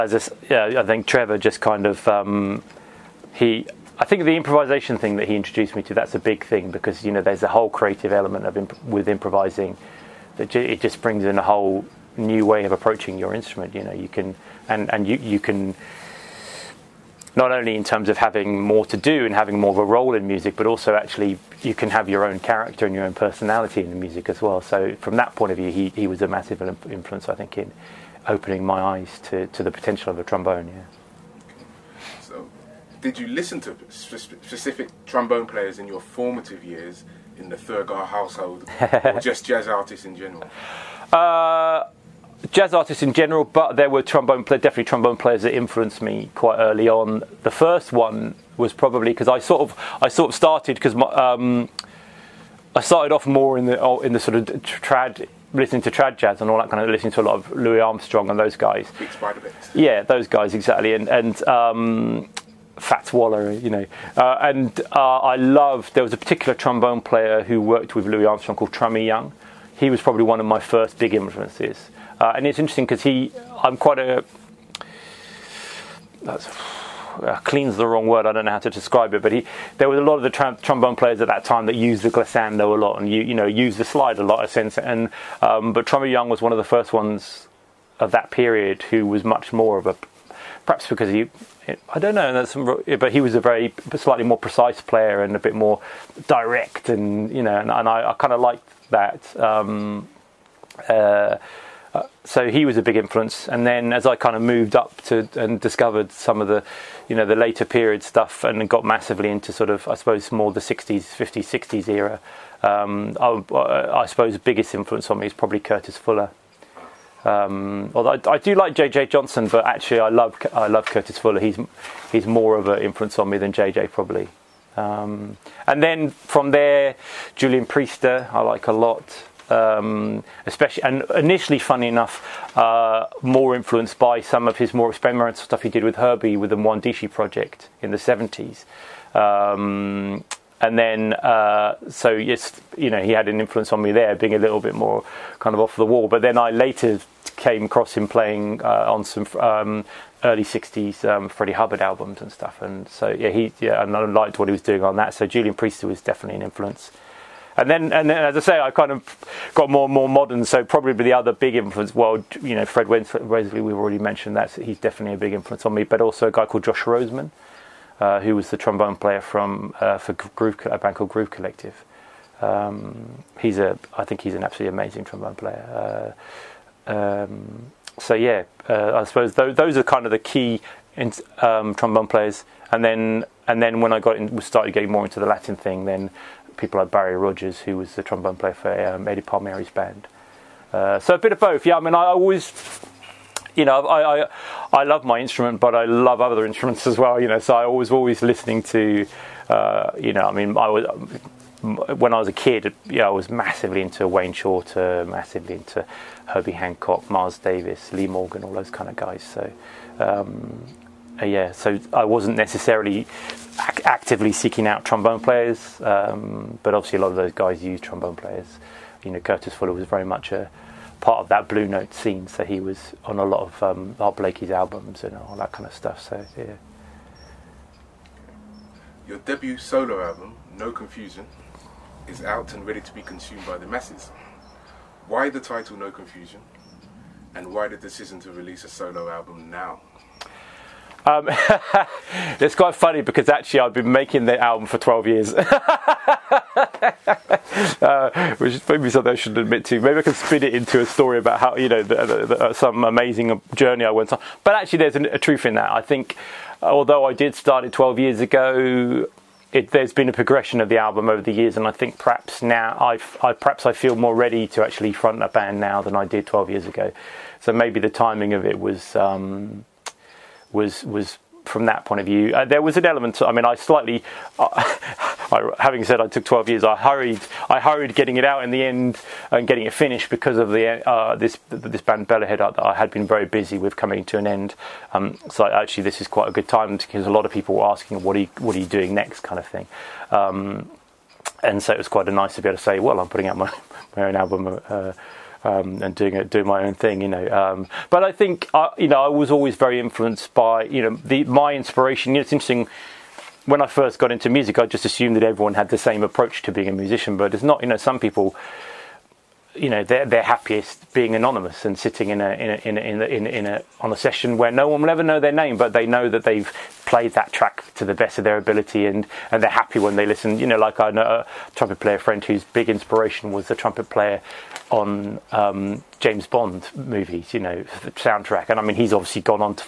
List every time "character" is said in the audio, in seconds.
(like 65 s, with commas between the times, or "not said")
22 s.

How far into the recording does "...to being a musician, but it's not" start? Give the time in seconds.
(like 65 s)
306 s.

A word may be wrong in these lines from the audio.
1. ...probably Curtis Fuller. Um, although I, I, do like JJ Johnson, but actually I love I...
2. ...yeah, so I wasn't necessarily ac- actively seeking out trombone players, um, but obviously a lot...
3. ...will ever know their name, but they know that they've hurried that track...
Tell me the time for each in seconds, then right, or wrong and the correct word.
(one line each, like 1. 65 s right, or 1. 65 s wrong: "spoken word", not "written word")
1. 115 s right
2. 211 s right
3. 314 s wrong: "played", not "hurried".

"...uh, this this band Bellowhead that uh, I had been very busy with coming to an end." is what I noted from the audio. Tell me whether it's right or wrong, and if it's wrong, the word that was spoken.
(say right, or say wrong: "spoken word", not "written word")
right.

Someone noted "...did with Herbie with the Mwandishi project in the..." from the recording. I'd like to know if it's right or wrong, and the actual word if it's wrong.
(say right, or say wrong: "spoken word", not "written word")
right.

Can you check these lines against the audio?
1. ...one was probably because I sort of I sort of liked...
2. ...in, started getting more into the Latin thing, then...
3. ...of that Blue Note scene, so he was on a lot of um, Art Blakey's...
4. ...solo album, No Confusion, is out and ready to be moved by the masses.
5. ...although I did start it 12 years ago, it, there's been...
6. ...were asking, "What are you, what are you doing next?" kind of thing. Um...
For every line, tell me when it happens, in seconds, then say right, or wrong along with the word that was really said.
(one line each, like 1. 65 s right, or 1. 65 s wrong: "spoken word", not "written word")
1. 47 s wrong: "started", not "liked"
2. 184 s right
3. 221 s right
4. 229 s wrong: "consumed", not "moved"
5. 256 s right
6. 287 s right.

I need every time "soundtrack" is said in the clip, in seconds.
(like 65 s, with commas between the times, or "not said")
327 s.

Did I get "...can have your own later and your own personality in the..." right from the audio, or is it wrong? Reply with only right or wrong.
wrong.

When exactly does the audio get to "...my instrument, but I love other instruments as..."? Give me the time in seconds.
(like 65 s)
195 s.